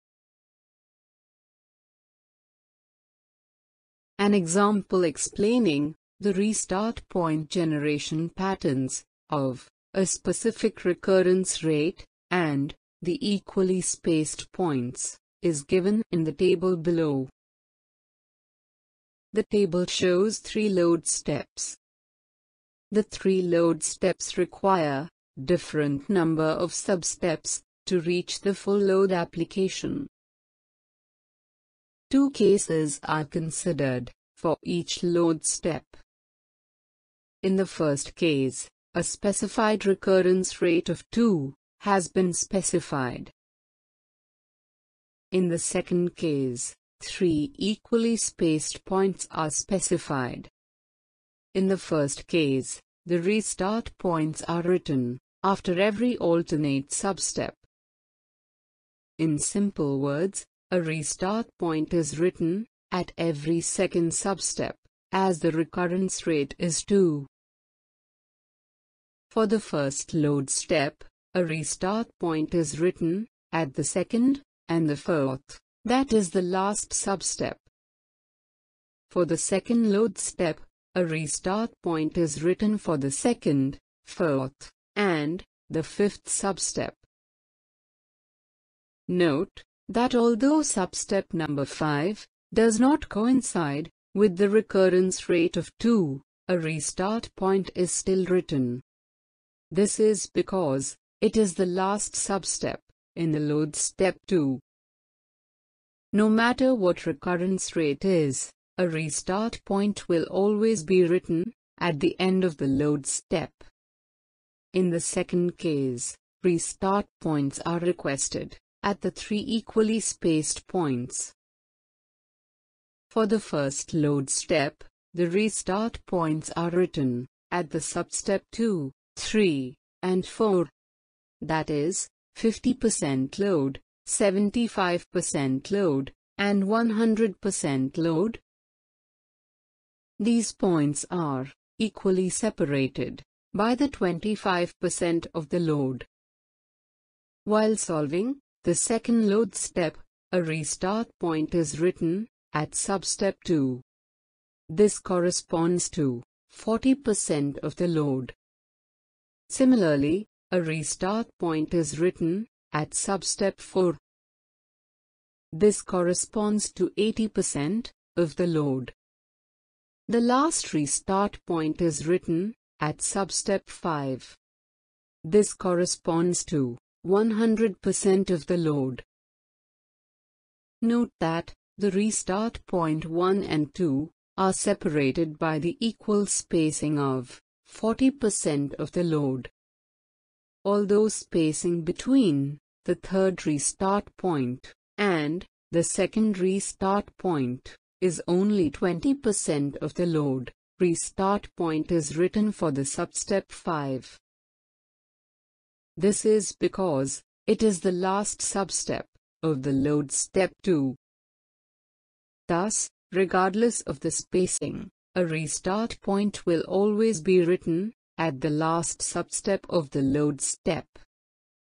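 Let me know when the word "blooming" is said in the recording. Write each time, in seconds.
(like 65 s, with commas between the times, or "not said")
not said.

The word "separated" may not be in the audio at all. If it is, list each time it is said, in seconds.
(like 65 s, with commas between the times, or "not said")
142 s, 184 s.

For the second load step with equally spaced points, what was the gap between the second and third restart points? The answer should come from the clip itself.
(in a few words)
20%.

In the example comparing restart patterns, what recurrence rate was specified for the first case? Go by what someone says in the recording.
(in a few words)
2.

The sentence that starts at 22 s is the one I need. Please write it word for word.
The three load steps require different number of substeps to reach the full load application.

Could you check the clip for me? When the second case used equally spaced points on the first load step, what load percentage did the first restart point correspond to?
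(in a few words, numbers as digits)
50%.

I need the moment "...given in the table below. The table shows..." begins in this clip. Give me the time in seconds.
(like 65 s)
15 s.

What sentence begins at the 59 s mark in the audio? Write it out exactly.
In simple words, a restart point is written at every second substep, as the recurrence rate is 2.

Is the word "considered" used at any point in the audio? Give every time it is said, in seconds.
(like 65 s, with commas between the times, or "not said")
33 s.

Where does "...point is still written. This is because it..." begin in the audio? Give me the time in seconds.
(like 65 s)
97 s.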